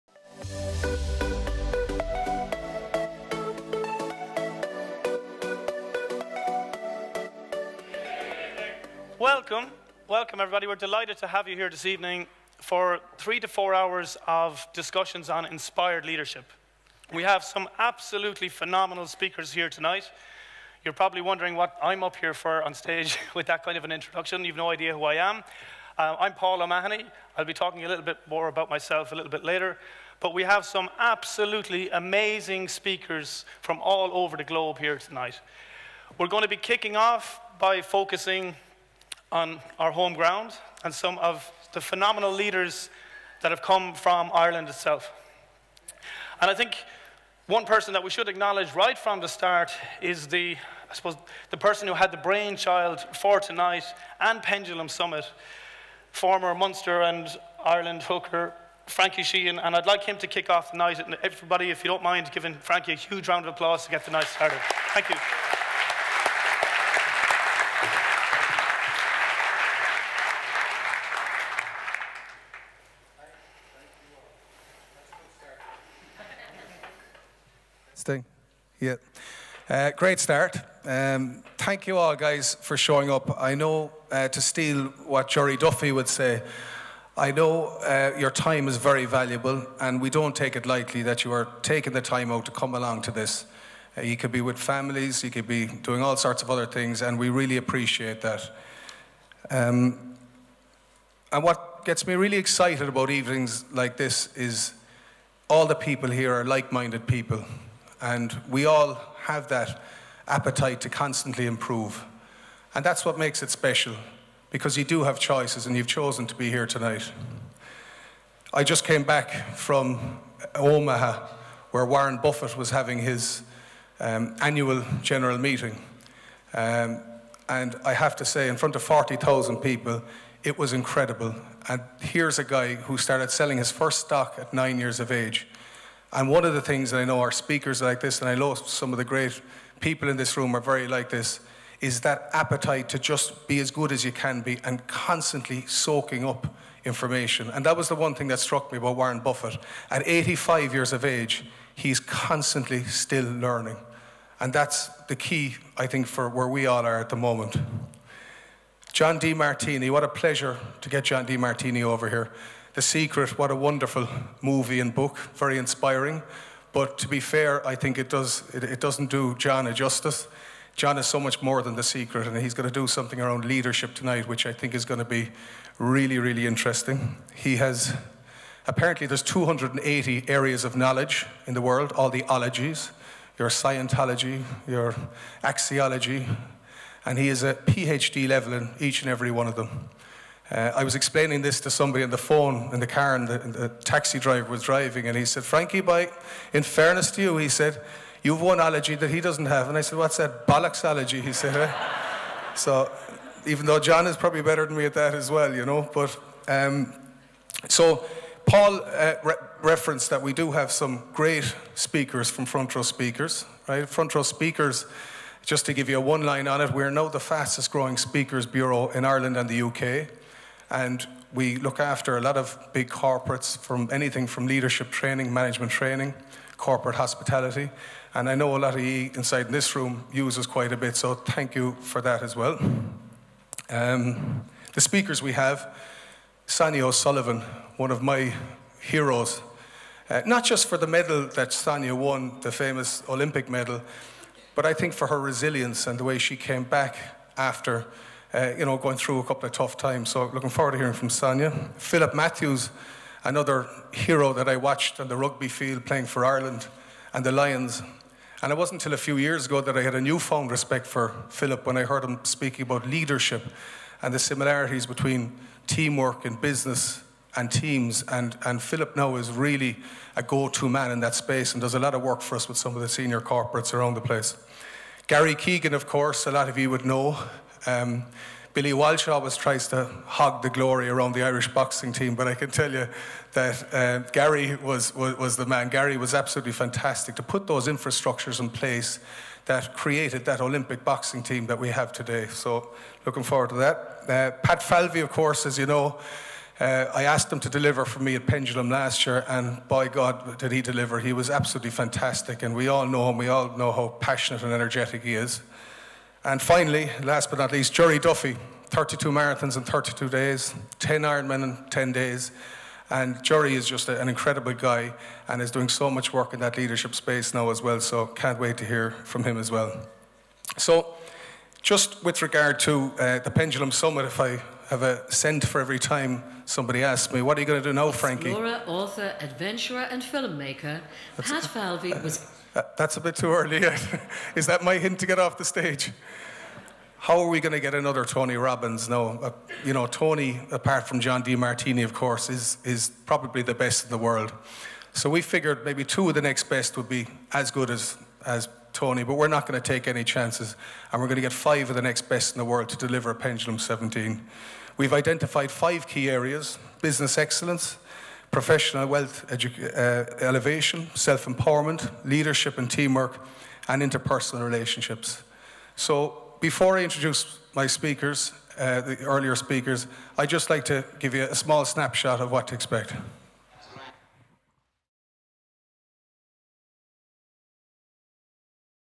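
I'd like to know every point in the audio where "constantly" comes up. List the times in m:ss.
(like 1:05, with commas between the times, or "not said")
1:50, 2:24, 2:32.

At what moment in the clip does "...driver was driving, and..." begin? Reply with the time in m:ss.
3:14.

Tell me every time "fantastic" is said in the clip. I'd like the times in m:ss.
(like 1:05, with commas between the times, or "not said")
4:46, 5:01.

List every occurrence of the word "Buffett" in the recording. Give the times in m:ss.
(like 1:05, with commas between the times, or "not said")
2:02, 2:29.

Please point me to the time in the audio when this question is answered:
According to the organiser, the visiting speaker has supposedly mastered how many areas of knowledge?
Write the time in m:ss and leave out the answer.
2:59.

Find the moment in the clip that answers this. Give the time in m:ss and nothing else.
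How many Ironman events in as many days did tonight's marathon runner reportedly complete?
5:10.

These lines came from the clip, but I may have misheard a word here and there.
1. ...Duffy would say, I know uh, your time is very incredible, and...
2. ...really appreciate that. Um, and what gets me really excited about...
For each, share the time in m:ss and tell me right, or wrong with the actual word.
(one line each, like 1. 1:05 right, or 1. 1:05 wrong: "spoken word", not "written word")
1. 1:25 wrong: "valuable", not "incredible"
2. 1:37 right.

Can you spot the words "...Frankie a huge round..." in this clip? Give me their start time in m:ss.
1:02.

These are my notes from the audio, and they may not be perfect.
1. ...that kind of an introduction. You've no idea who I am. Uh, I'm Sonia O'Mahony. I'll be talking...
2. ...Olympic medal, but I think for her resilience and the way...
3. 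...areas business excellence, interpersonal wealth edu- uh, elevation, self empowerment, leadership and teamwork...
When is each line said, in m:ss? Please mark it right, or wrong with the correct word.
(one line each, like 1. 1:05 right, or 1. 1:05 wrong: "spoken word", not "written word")
1. 0:23 wrong: "Paul", not "Sonia"
2. 4:03 right
3. 5:56 wrong: "professional", not "interpersonal".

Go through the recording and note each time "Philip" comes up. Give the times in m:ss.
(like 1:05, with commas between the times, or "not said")
4:11, 4:21, 4:28.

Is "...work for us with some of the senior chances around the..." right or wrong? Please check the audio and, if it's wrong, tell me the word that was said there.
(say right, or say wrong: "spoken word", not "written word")
wrong: "corporates", not "chances".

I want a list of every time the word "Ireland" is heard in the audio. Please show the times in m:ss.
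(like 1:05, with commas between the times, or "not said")
0:44, 0:57, 3:39, 4:16.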